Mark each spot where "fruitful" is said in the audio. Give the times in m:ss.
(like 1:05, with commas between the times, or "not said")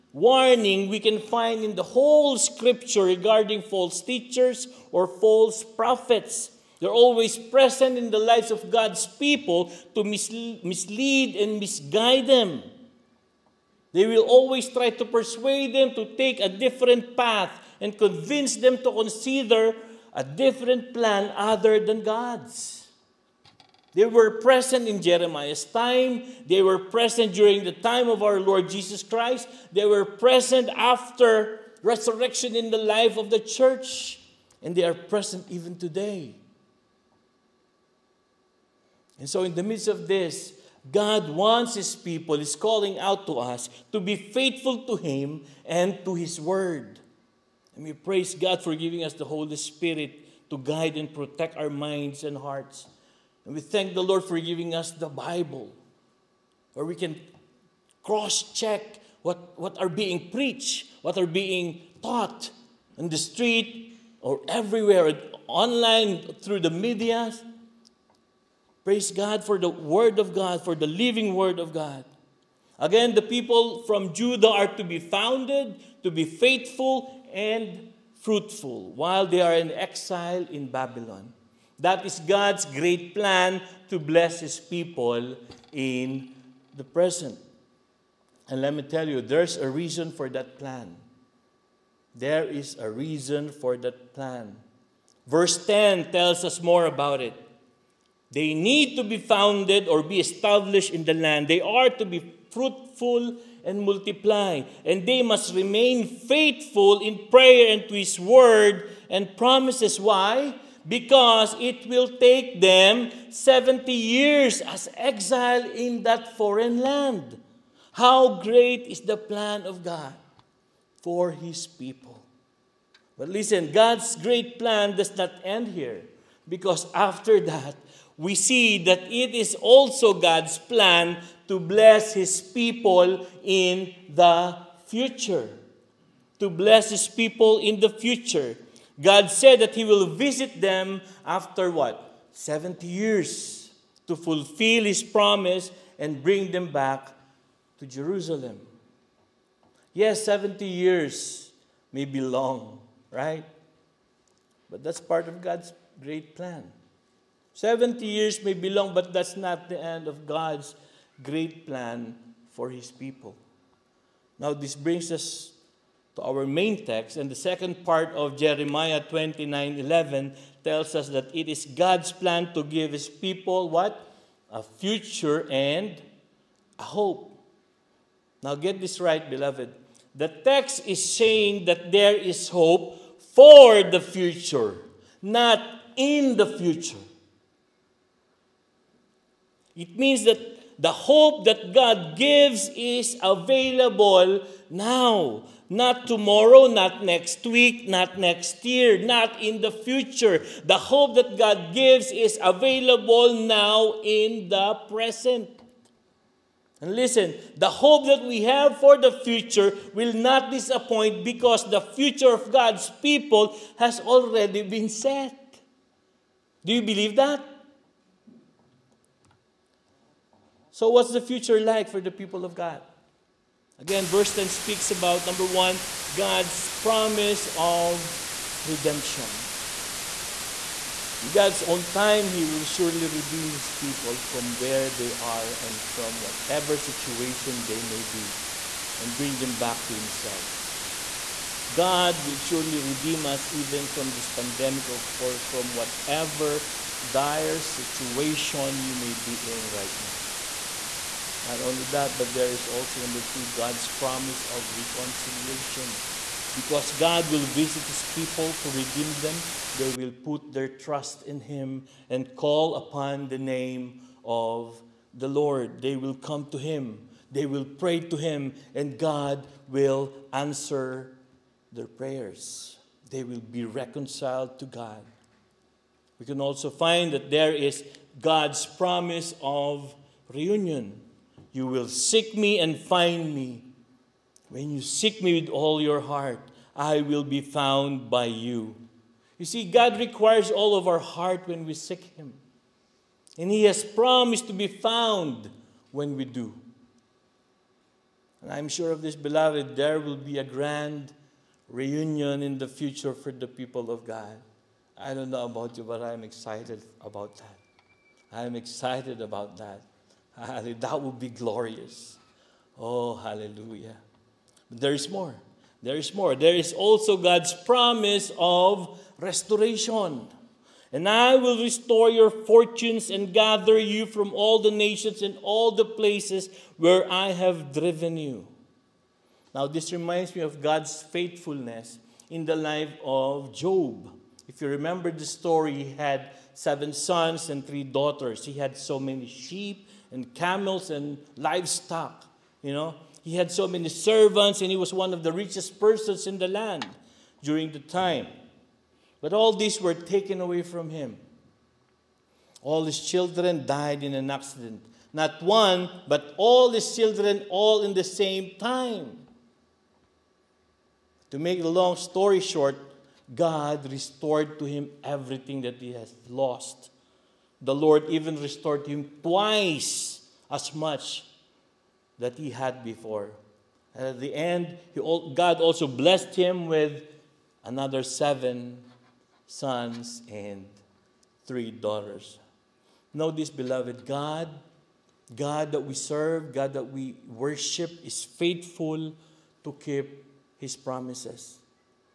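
1:18, 1:42.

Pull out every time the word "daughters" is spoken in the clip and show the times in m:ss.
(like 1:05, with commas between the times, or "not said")
5:37, 6:21.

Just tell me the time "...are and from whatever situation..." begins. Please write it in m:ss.
3:55.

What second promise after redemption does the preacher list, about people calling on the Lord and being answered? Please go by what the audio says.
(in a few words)
Reconciliation.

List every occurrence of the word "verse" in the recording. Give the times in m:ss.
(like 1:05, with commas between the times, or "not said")
1:35, 3:44.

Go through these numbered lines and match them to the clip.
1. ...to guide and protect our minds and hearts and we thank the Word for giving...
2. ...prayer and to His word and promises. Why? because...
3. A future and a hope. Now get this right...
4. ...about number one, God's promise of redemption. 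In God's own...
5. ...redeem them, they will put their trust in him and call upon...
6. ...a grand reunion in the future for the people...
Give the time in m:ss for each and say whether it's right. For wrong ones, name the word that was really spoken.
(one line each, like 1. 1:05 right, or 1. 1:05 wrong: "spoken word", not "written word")
1. 0:50 wrong: "Lord", not "Word"
2. 1:47 right
3. 2:54 right
4. 3:44 right
5. 4:18 right
6. 5:00 right.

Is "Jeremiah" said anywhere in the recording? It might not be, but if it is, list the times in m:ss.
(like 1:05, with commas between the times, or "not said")
0:25, 2:48.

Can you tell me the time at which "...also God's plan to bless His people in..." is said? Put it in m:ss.
2:09.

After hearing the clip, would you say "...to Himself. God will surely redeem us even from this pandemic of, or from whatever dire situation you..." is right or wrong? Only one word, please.
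right.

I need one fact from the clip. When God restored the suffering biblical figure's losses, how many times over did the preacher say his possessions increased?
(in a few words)
Twice.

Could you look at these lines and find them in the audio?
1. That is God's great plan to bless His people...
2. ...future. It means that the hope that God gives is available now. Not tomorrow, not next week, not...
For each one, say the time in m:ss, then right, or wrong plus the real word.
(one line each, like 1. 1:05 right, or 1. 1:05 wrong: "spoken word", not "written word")
1. 1:21 right
2. 3:06 right.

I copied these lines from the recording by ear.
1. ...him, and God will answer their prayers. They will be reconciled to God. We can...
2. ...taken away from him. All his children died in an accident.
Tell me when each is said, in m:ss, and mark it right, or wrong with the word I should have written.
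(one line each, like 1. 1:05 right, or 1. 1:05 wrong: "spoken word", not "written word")
1. 4:28 right
2. 5:49 right.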